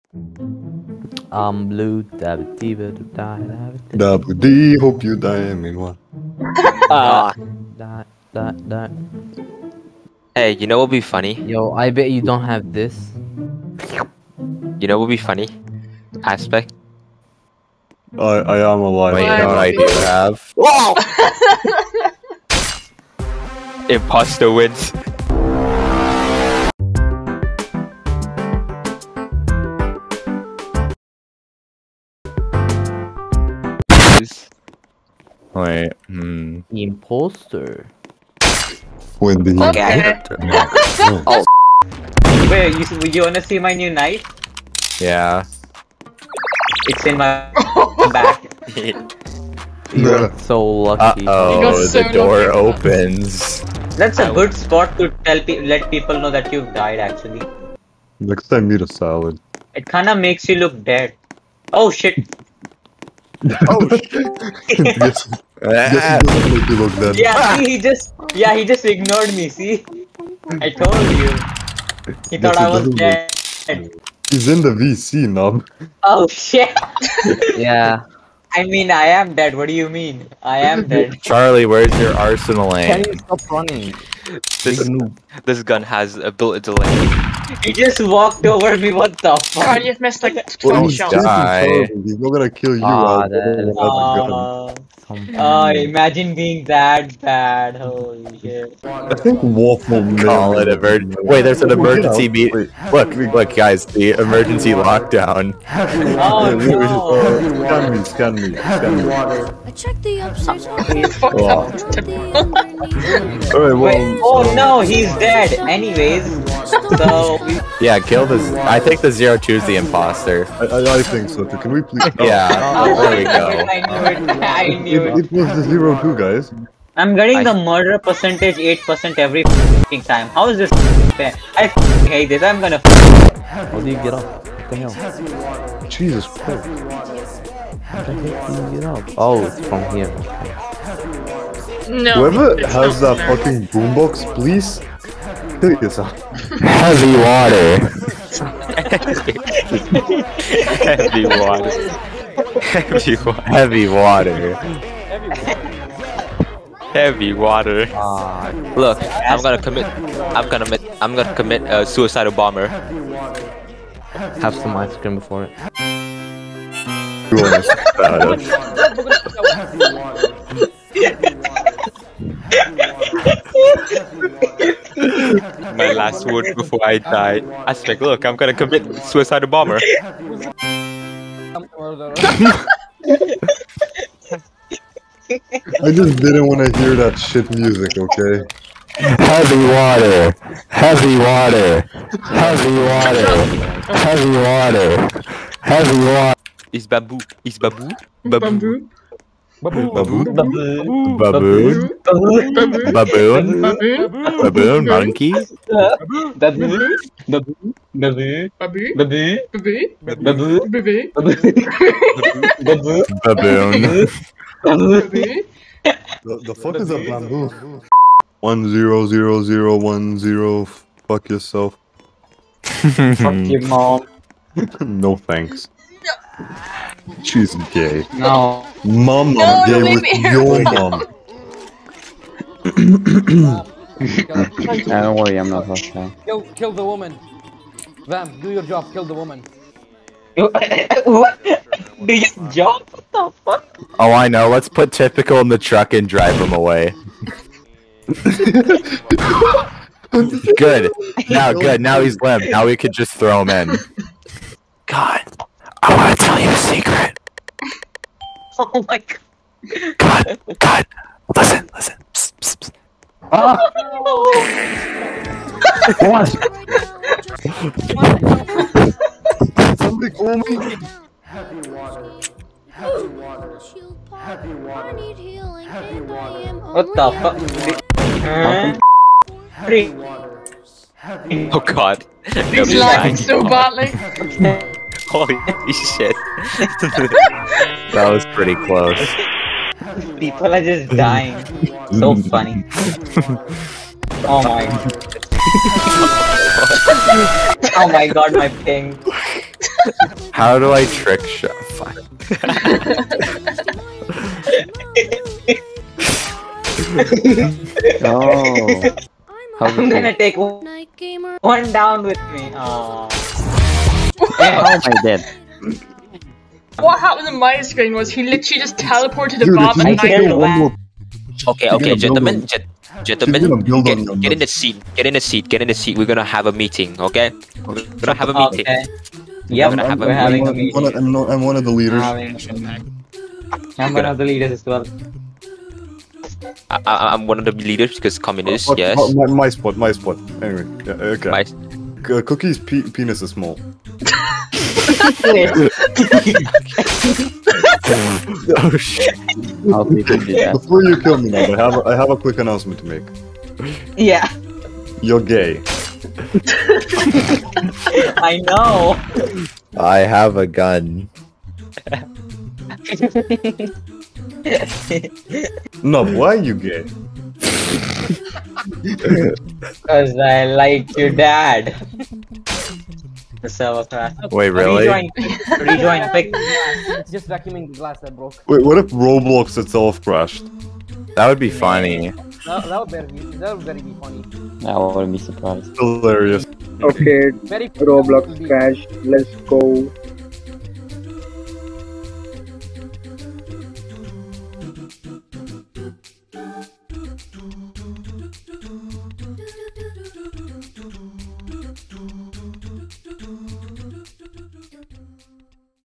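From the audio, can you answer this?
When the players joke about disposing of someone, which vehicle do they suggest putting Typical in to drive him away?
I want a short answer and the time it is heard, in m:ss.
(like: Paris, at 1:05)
truck, at 4:05.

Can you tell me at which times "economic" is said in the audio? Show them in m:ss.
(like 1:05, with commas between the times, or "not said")
not said.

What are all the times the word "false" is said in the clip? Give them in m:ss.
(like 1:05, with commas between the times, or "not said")
not said.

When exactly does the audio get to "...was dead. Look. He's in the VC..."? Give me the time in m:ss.
1:12.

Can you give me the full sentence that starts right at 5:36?
I, am one of the leaders because communist.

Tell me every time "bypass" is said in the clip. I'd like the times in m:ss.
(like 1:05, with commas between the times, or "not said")
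not said.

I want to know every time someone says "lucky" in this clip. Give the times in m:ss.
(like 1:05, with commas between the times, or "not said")
0:50.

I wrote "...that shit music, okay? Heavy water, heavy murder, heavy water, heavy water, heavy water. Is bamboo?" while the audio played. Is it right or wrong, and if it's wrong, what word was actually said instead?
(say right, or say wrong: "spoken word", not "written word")
wrong: "water", not "murder".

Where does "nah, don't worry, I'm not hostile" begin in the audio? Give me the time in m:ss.
3:53.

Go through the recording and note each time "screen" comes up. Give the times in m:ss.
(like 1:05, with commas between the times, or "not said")
5:17.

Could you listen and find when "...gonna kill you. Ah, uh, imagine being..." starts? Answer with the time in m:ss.
1:32.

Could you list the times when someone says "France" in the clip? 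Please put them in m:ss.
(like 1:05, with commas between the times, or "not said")
not said.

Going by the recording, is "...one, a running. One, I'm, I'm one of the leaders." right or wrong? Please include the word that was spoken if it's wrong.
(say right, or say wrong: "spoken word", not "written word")
wrong: "meeting", not "running".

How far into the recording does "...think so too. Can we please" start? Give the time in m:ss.
2:01.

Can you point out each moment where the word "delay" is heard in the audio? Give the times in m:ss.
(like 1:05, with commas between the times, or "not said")
1:26.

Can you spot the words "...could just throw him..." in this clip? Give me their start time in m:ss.
4:12.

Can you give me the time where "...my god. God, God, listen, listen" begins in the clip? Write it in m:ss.
4:18.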